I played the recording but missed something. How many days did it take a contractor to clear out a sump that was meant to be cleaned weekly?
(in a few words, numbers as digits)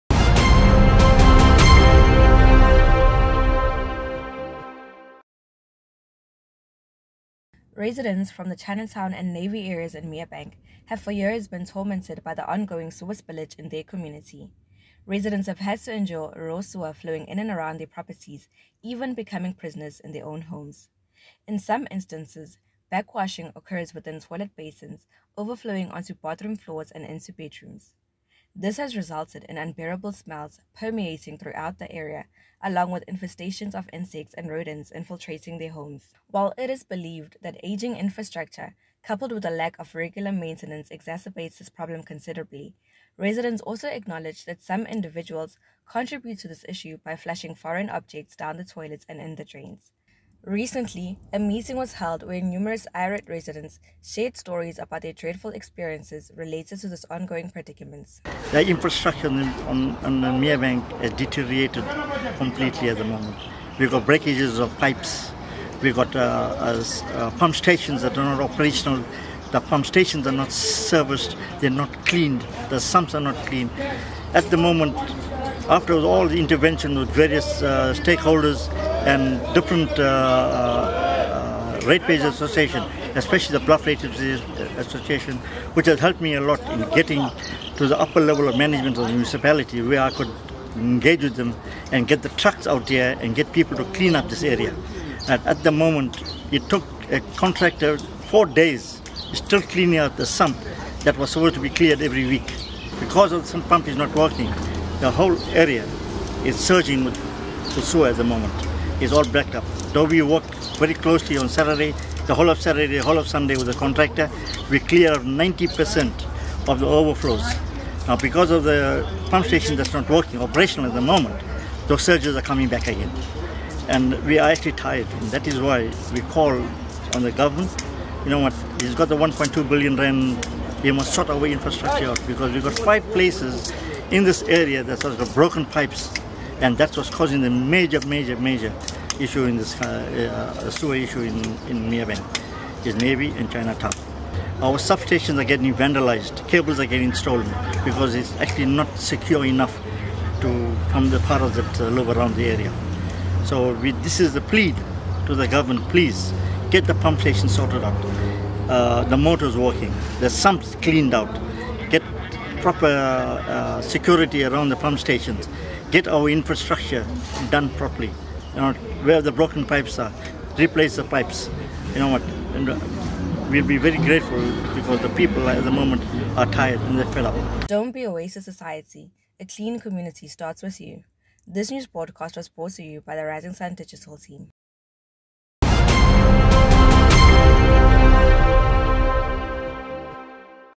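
4.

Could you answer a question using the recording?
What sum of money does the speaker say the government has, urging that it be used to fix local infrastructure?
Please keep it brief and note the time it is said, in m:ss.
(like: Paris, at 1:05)
1.2 billion rand, at 2:09.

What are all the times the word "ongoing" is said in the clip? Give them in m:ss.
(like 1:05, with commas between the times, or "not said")
0:12, 0:57.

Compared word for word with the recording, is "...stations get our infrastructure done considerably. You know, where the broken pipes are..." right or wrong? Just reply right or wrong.
wrong.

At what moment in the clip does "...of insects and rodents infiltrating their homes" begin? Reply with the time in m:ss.
0:33.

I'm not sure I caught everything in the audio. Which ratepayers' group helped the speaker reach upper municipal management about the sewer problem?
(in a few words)
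Bluff Ratepayers' Association.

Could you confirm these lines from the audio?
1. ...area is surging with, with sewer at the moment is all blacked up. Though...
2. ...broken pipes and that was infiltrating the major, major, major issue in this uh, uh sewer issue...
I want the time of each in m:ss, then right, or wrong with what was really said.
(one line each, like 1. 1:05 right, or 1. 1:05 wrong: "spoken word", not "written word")
1. 1:45 right
2. 2:15 wrong: "causing", not "infiltrating".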